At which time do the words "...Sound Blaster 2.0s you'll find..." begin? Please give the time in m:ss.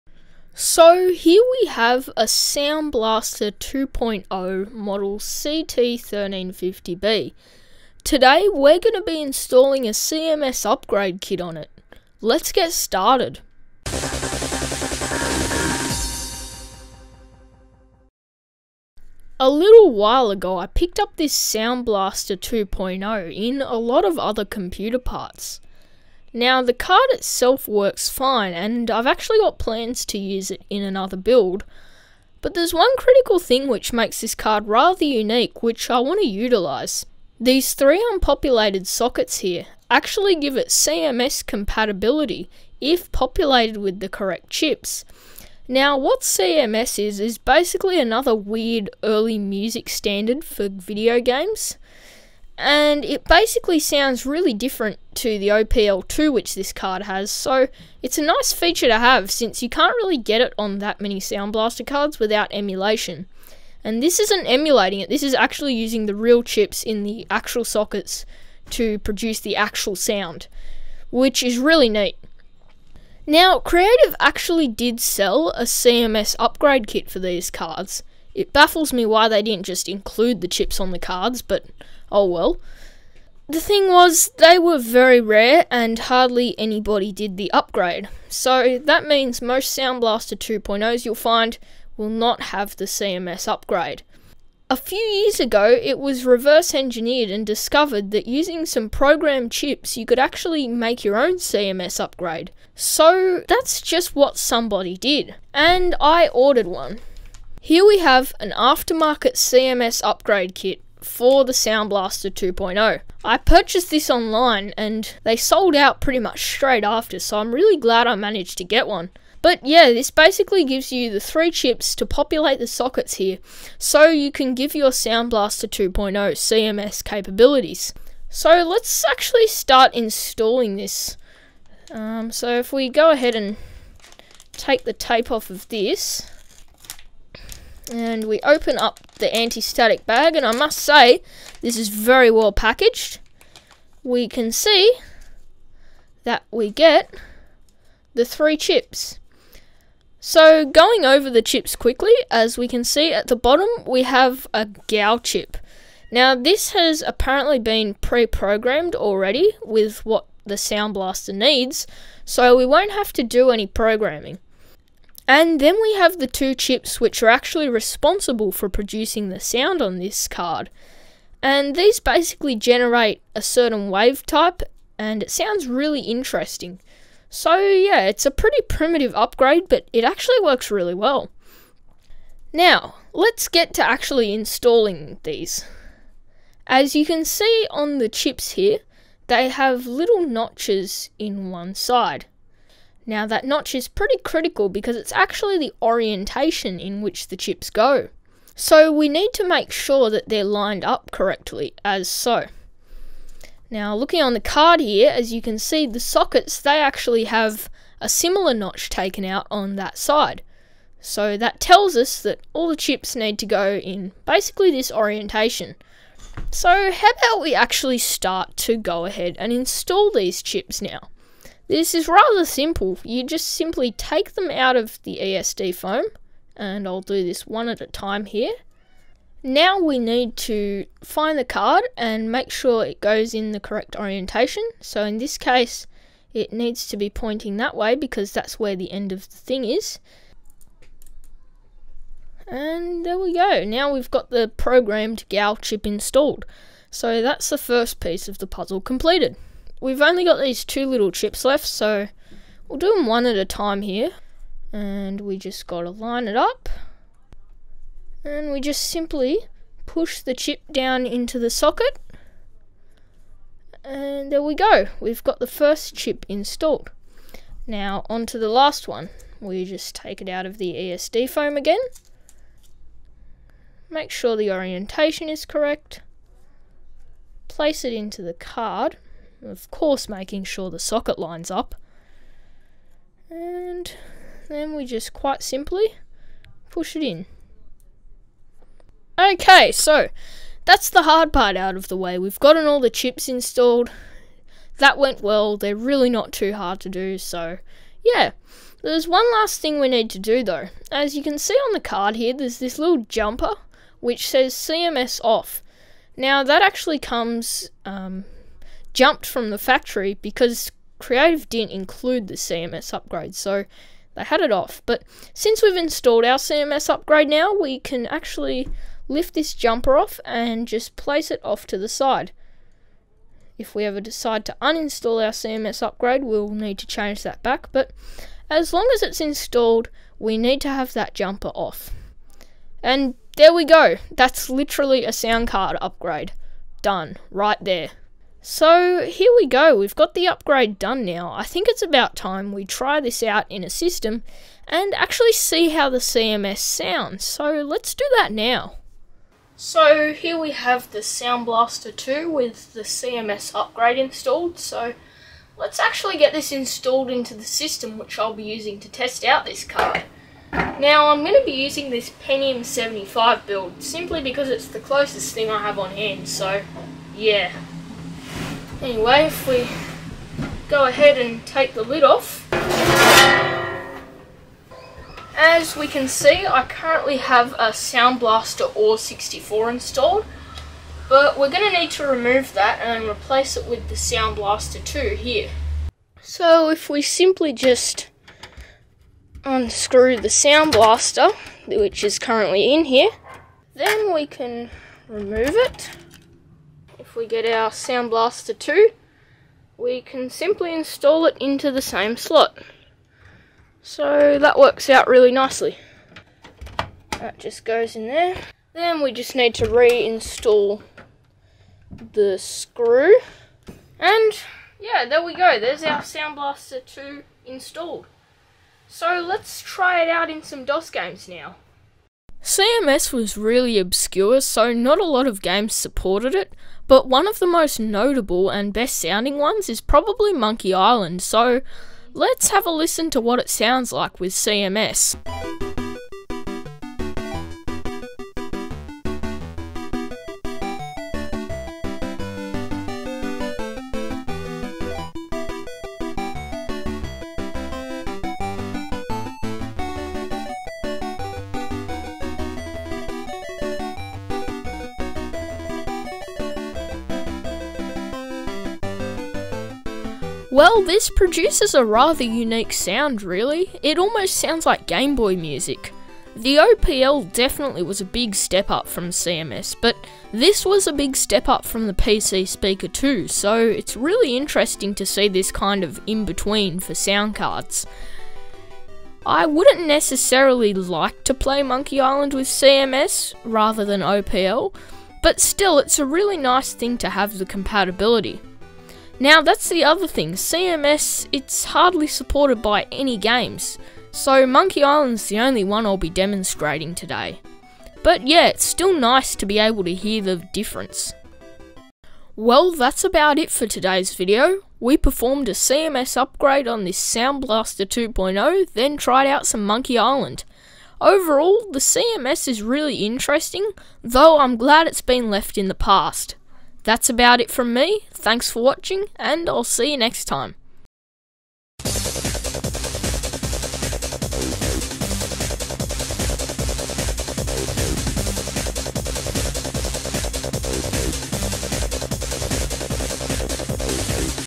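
1:29.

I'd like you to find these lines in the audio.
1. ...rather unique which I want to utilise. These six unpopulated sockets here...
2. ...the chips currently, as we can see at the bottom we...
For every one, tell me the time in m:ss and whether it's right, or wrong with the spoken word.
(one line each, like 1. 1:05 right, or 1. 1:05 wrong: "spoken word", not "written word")
1. 0:34 wrong: "three", not "six"
2. 2:31 wrong: "quickly", not "currently".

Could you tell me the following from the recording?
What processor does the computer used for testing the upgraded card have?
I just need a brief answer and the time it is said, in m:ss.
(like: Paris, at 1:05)
Pentium 75, at 6:02.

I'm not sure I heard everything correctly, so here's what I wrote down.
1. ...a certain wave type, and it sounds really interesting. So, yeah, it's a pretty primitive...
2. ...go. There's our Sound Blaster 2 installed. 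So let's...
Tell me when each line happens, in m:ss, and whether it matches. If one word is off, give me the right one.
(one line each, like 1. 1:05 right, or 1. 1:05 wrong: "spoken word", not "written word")
1. 2:53 right
2. 6:55 right.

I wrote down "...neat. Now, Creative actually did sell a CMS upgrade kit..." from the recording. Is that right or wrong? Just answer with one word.
right.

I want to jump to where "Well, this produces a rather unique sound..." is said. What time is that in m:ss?
7:40.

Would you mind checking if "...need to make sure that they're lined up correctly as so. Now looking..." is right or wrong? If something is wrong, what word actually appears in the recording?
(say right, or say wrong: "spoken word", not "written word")
right.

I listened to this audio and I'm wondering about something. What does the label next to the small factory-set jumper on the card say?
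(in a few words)
CMS off.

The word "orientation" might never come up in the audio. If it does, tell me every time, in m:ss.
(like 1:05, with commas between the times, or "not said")
3:15, 3:34, 3:53, 4:34.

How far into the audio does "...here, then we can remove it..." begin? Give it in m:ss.
6:32.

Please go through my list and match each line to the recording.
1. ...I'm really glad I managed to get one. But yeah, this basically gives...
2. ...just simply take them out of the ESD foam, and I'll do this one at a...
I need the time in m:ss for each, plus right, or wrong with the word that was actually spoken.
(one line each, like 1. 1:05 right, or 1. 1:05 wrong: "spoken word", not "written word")
1. 1:57 right
2. 3:43 right.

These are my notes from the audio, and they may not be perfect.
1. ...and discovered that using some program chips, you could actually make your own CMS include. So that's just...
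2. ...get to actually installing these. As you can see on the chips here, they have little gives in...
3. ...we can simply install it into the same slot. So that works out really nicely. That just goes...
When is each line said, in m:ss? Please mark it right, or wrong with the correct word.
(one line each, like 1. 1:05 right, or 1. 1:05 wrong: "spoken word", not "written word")
1. 1:37 wrong: "upgrade", not "include"
2. 3:03 wrong: "notches", not "gives"
3. 6:39 right.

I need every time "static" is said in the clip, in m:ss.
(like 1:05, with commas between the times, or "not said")
2:19.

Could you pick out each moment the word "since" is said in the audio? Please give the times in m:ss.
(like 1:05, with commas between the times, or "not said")
0:59, 5:15.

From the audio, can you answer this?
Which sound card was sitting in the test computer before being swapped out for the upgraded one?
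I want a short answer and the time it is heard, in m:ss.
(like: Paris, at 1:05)
Sound Blaster AWE 64, at 6:17.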